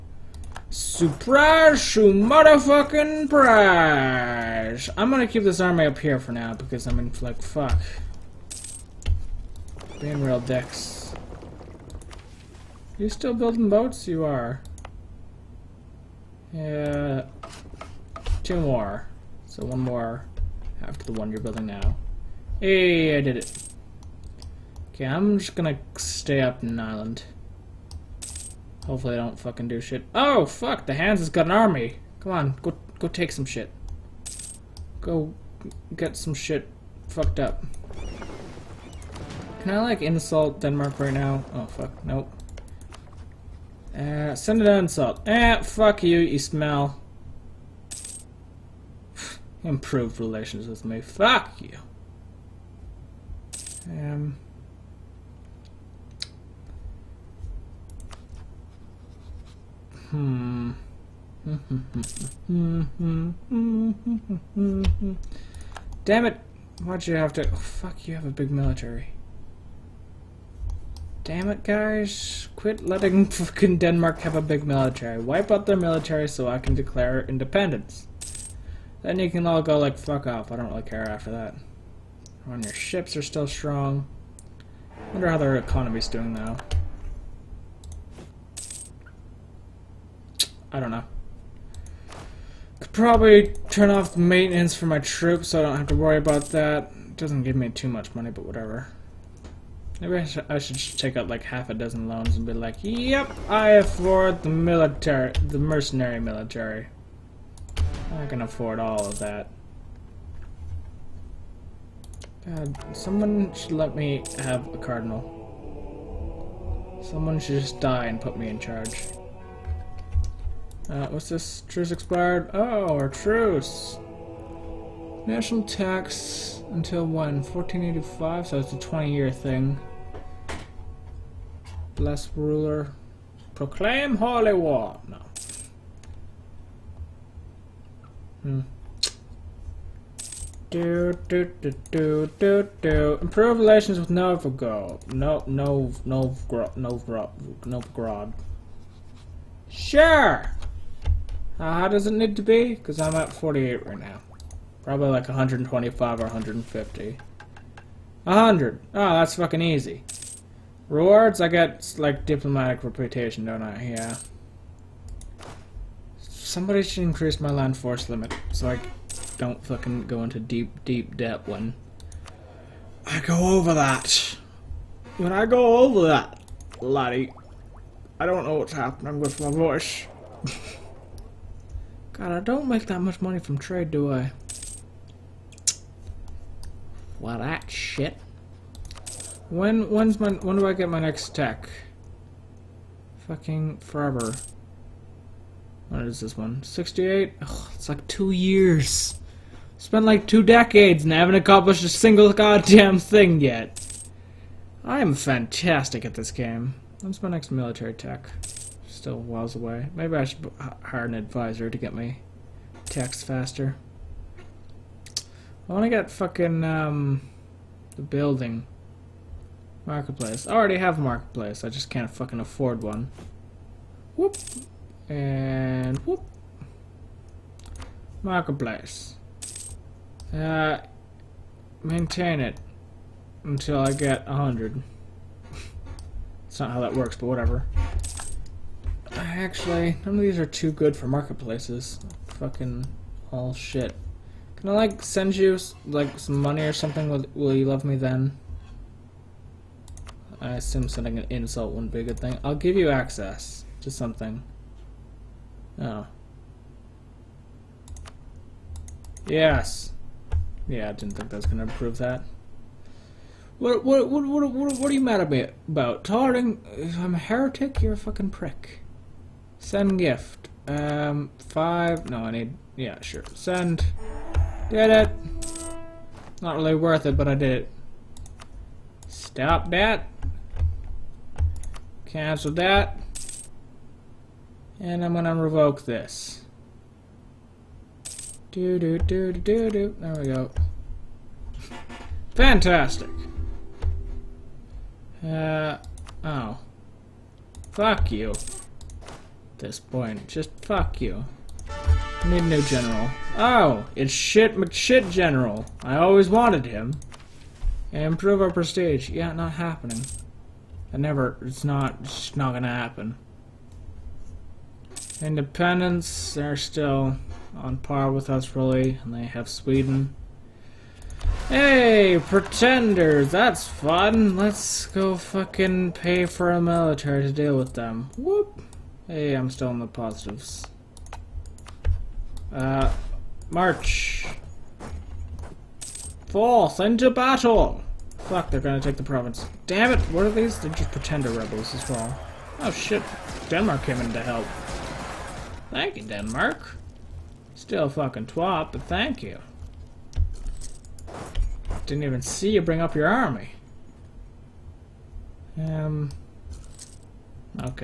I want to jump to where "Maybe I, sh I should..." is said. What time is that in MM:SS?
01:39.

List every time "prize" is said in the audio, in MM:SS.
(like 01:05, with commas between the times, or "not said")
00:03.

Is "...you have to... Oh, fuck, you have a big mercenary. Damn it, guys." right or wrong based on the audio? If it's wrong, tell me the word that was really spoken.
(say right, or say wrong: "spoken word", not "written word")
wrong: "military", not "mercenary".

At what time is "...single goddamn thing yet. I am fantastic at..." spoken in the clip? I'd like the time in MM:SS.
03:21.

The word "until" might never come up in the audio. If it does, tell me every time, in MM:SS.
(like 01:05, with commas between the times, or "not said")
02:06, 03:53.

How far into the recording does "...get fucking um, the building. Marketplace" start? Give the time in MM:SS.
03:35.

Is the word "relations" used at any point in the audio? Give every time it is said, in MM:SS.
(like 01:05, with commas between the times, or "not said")
00:50, 02:23.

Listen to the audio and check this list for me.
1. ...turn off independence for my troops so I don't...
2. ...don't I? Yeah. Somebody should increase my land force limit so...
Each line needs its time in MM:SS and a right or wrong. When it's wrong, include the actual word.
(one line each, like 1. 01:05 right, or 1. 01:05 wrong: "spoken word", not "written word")
1. 01:33 wrong: "maintenance", not "independence"
2. 02:43 right.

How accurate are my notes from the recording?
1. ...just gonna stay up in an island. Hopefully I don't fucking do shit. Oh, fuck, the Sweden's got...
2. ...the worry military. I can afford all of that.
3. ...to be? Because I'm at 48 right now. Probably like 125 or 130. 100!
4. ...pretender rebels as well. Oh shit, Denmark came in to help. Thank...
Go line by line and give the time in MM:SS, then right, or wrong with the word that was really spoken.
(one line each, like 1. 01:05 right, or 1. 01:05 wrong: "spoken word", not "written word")
1. 00:25 wrong: "Hansa", not "Sweden"
2. 01:45 wrong: "mercenary", not "worry"
3. 02:32 wrong: "150", not "130"
4. 05:40 right.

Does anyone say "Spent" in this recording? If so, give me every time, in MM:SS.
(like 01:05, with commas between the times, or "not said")
03:19.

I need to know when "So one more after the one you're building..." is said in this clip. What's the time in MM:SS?
00:19.